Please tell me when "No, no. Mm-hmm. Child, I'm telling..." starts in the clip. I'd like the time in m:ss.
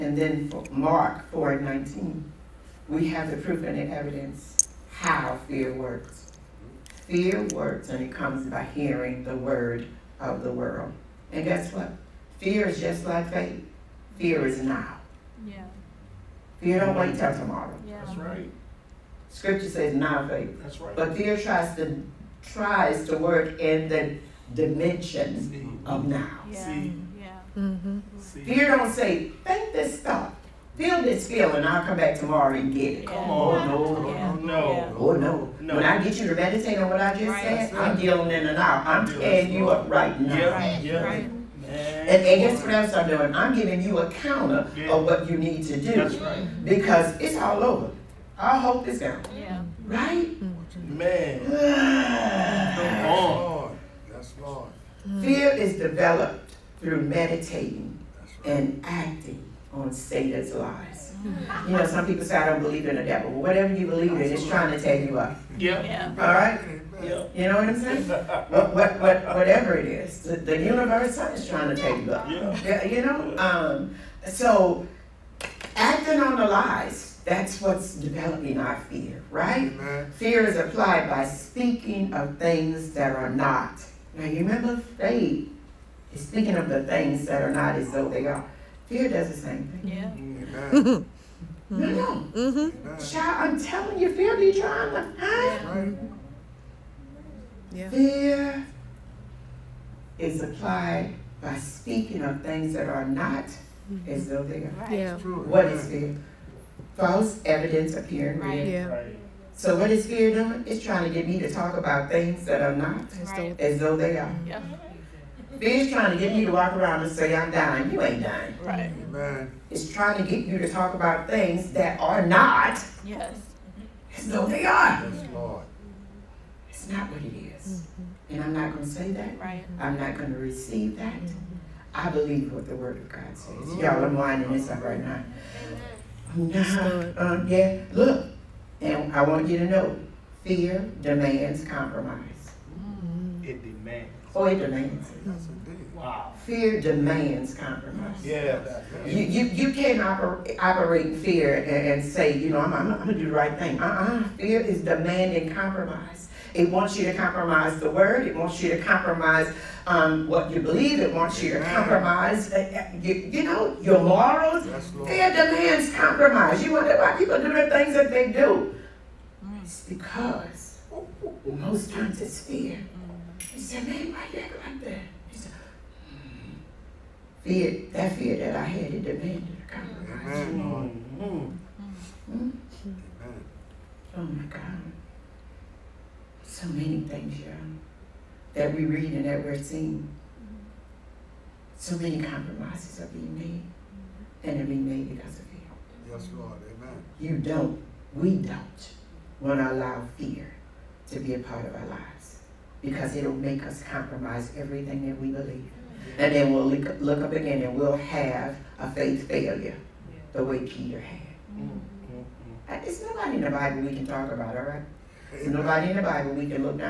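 1:31.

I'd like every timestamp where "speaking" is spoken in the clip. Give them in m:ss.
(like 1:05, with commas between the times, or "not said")
1:21, 1:26, 1:41.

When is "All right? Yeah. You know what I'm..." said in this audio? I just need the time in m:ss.
1:06.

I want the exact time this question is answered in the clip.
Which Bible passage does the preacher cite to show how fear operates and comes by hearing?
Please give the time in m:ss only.
0:00.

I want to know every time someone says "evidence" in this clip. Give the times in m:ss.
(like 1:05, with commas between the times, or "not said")
0:03, 1:47.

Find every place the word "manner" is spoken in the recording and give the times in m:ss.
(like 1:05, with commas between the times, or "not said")
not said.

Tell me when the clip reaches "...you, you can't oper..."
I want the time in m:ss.
2:29.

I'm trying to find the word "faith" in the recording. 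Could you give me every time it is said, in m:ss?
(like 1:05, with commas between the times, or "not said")
0:13, 0:20, 0:29, 1:24, 3:28.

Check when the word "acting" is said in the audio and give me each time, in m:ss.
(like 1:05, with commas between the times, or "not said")
0:58, 1:15.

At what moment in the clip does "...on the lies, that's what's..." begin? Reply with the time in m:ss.
1:16.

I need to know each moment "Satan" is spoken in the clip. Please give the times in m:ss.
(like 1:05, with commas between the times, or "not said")
0:59.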